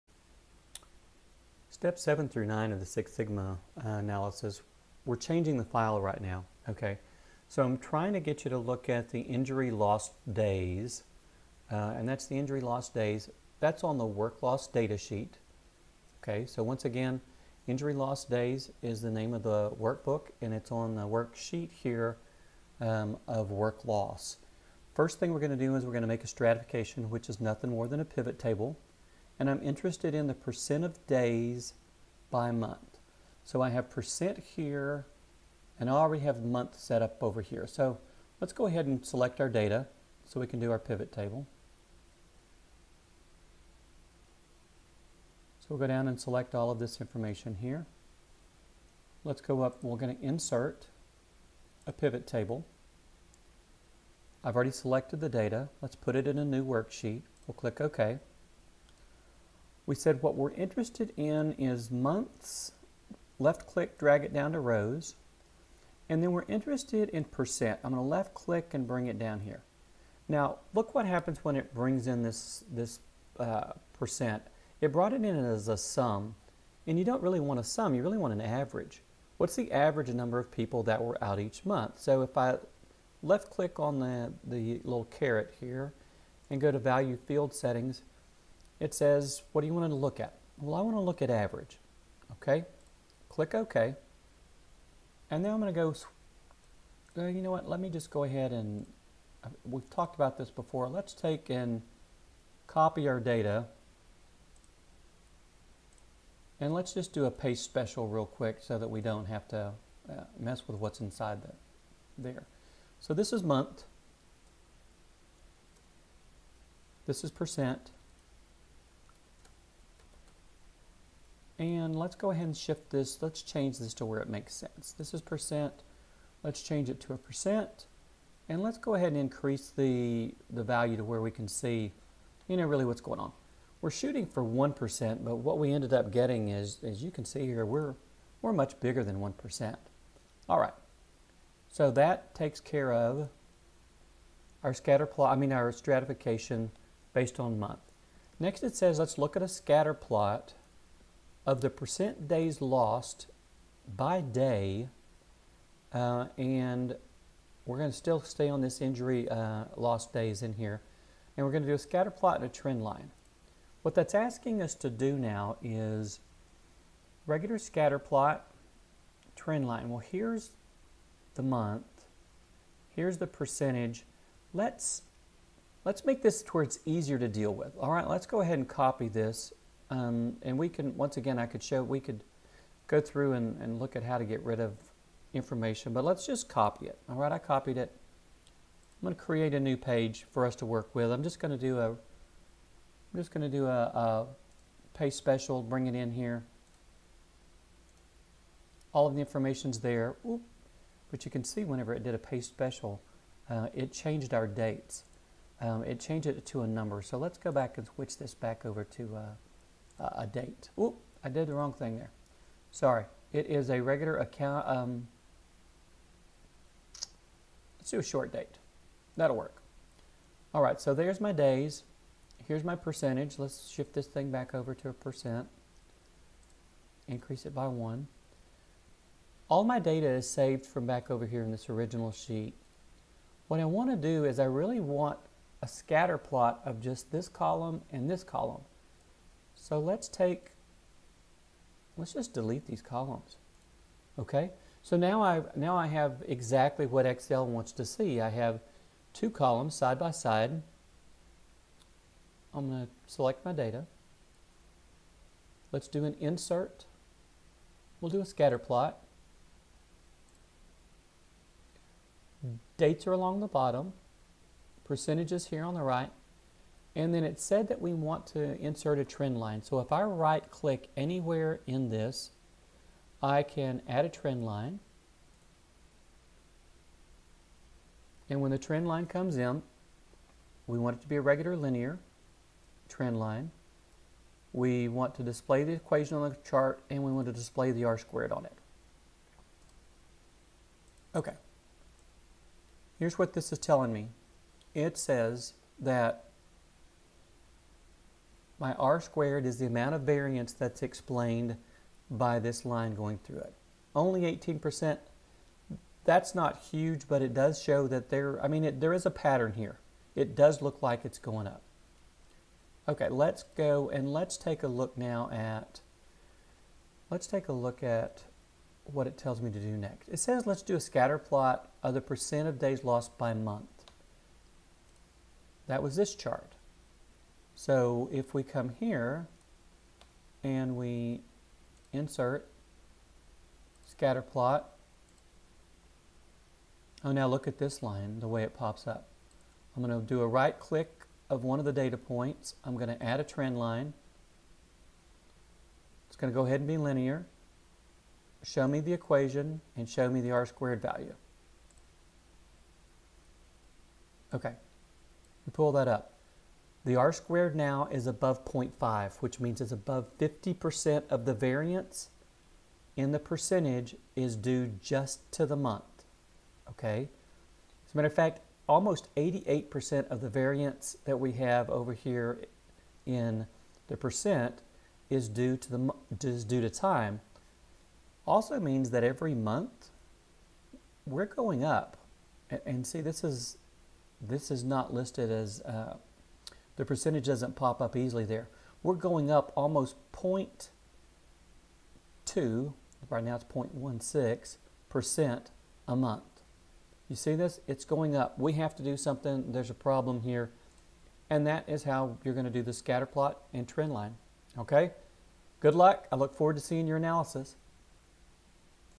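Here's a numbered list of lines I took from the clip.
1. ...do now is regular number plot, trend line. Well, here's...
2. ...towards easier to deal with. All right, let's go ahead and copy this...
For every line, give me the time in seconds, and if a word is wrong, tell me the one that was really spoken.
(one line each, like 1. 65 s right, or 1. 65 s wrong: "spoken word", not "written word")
1. 164 s wrong: "scatter", not "number"
2. 176 s right.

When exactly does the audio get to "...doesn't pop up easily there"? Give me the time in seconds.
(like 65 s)
387 s.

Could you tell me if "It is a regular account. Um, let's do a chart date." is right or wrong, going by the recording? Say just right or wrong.
wrong.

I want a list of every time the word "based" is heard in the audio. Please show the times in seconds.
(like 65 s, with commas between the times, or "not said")
147 s.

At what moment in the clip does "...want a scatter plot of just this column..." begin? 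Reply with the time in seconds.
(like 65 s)
234 s.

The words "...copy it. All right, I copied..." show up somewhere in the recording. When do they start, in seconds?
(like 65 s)
186 s.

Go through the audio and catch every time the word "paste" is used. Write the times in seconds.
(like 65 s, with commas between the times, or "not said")
107 s, 194 s, 202 s.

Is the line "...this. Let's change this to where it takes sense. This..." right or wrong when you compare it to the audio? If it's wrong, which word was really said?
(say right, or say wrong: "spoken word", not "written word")
wrong: "makes", not "takes".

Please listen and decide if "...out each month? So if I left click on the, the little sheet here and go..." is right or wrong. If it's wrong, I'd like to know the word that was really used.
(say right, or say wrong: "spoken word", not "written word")
wrong: "caret", not "sheet".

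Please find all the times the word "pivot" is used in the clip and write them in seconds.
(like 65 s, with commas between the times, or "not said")
28 s, 40 s, 51 s.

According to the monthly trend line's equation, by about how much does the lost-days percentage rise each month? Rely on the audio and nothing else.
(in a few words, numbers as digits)
0.16%.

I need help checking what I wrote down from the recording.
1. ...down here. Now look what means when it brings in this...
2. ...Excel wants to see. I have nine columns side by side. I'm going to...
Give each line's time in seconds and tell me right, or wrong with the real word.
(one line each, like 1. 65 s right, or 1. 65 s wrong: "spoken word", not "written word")
1. 69 s wrong: "happens", not "means"
2. 247 s wrong: "two", not "nine".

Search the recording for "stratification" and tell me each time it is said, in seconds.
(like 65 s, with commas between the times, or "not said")
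26 s, 145 s.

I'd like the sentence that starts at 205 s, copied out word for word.
Um, it changed it to a number.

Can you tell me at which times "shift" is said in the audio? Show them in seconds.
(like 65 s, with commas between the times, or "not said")
122 s, 223 s.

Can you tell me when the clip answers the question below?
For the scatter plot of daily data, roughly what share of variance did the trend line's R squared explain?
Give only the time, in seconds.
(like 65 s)
304 s.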